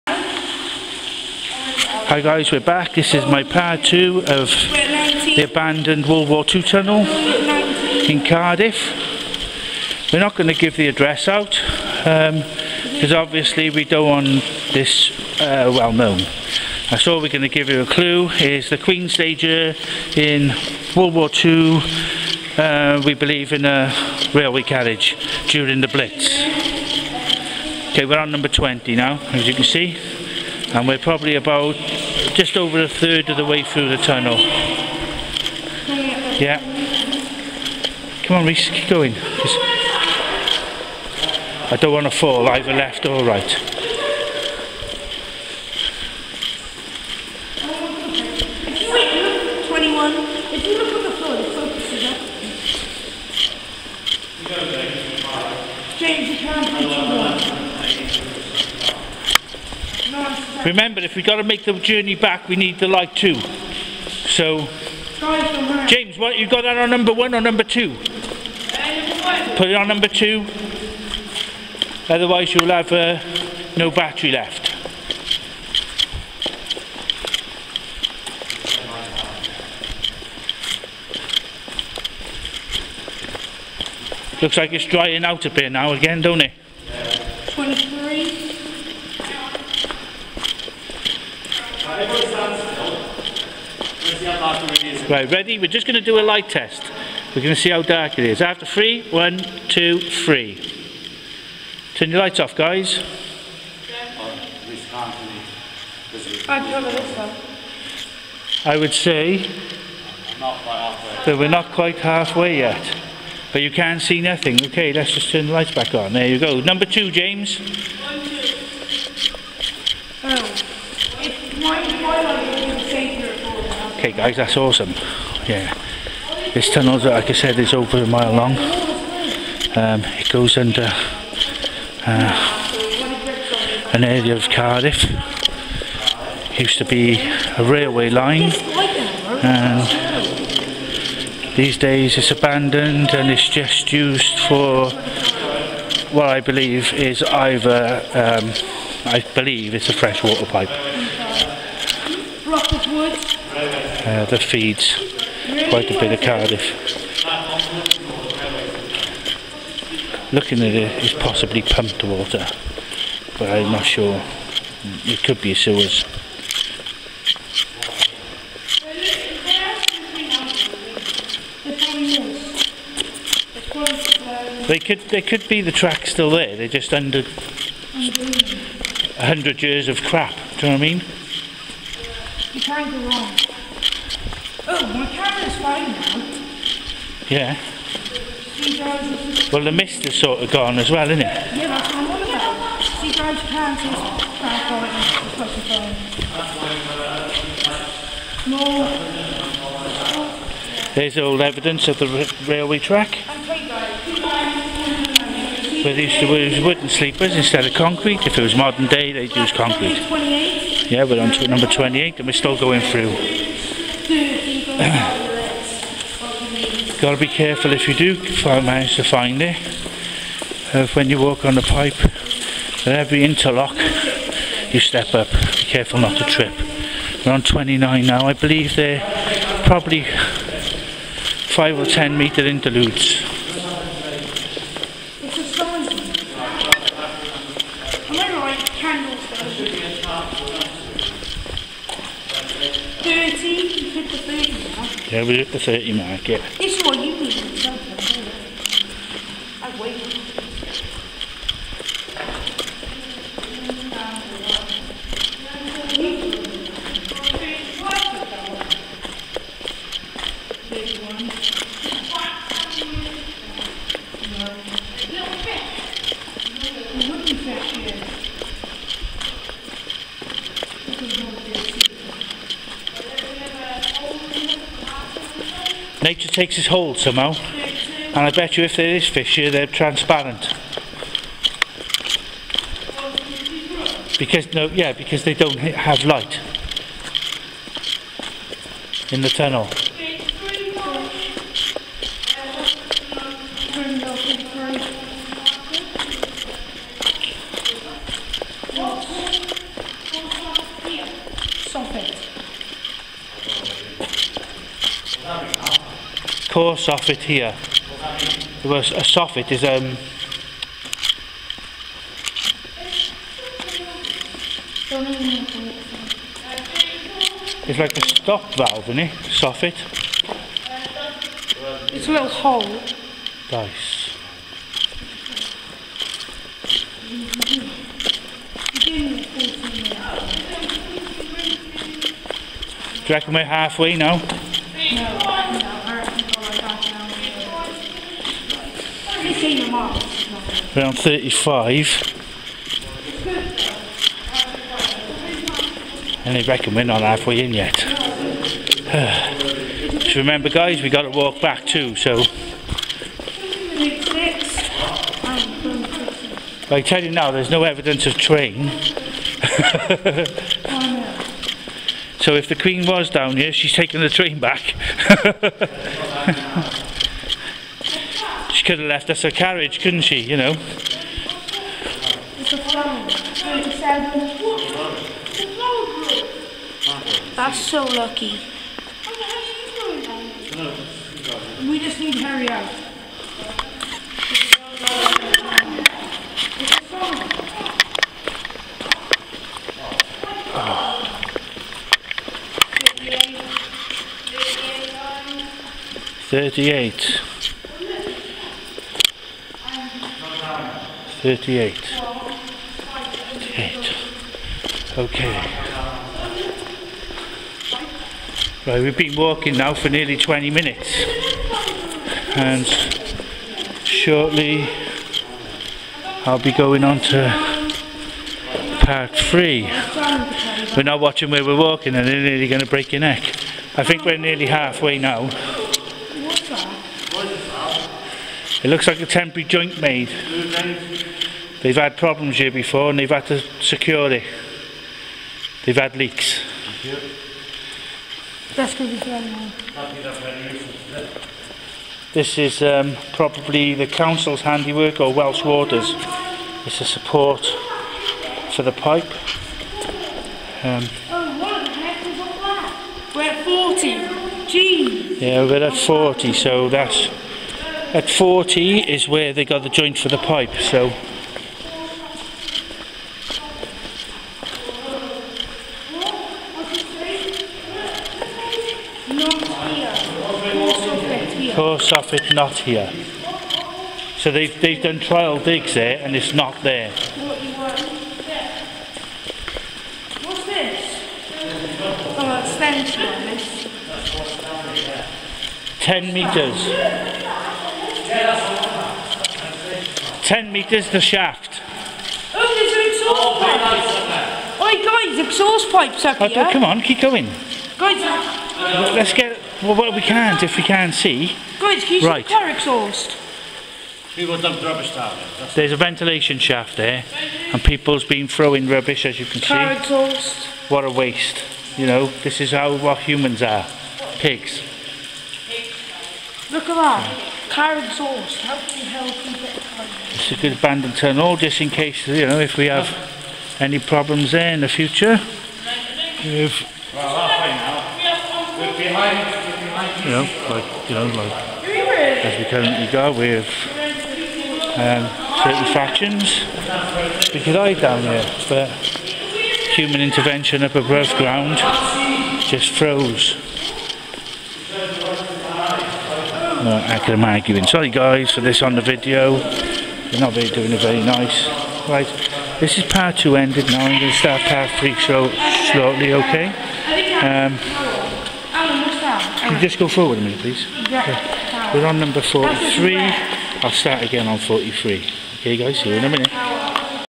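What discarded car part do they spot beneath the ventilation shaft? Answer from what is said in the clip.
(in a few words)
An exhaust pipe.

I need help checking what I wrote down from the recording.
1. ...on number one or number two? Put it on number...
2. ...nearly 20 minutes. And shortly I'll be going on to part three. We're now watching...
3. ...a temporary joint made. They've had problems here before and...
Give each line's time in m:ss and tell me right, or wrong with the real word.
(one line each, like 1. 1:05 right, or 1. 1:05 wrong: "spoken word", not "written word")
1. 1:06 right
2. 6:49 right
3. 7:08 right.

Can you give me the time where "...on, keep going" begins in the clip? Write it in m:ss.
8:16.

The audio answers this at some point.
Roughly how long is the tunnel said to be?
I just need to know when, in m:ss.
2:07.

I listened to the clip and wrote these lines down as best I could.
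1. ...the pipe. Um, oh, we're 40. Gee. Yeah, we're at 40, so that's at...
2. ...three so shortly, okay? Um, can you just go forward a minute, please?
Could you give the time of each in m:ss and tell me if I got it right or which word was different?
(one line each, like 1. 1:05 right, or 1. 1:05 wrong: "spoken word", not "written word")
1. 7:28 right
2. 9:14 right.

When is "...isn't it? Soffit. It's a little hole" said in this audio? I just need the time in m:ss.
5:18.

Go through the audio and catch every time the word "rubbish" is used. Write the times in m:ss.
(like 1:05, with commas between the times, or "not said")
8:24, 8:28.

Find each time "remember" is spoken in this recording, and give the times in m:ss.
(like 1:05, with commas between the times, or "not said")
1:00, 5:50.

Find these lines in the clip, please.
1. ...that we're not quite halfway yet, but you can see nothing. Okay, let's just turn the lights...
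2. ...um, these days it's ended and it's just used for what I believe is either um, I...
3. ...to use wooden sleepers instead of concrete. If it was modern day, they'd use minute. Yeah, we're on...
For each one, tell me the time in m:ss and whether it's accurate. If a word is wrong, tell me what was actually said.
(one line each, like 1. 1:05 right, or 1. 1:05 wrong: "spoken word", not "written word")
1. 1:50 right
2. 2:19 wrong: "abandoned", not "ended"
3. 3:26 wrong: "concrete", not "minute".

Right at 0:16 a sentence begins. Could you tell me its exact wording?
I so thought we're going to give you a clue.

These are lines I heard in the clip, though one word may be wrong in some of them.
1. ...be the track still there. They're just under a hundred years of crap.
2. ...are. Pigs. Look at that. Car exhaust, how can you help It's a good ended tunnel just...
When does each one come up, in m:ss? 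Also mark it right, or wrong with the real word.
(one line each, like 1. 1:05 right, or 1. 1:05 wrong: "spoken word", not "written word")
1. 2:55 right
2. 8:33 wrong: "abandoned", not "ended".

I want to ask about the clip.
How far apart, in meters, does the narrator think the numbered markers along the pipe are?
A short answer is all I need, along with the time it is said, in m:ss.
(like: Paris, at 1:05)
5 or 10 meters, at 3:50.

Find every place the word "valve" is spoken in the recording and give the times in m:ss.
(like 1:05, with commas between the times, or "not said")
5:18.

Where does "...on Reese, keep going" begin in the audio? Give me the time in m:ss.
0:38.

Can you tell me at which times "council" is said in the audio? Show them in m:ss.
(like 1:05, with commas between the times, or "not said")
7:23.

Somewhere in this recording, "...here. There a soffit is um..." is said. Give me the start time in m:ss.
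5:07.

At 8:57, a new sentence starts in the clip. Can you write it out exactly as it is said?
We could hide down here, but human intervention up above ground just froze.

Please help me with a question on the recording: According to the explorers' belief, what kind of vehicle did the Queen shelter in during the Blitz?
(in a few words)
A railway carriage.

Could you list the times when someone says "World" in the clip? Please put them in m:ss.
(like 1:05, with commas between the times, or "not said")
0:06, 0:20.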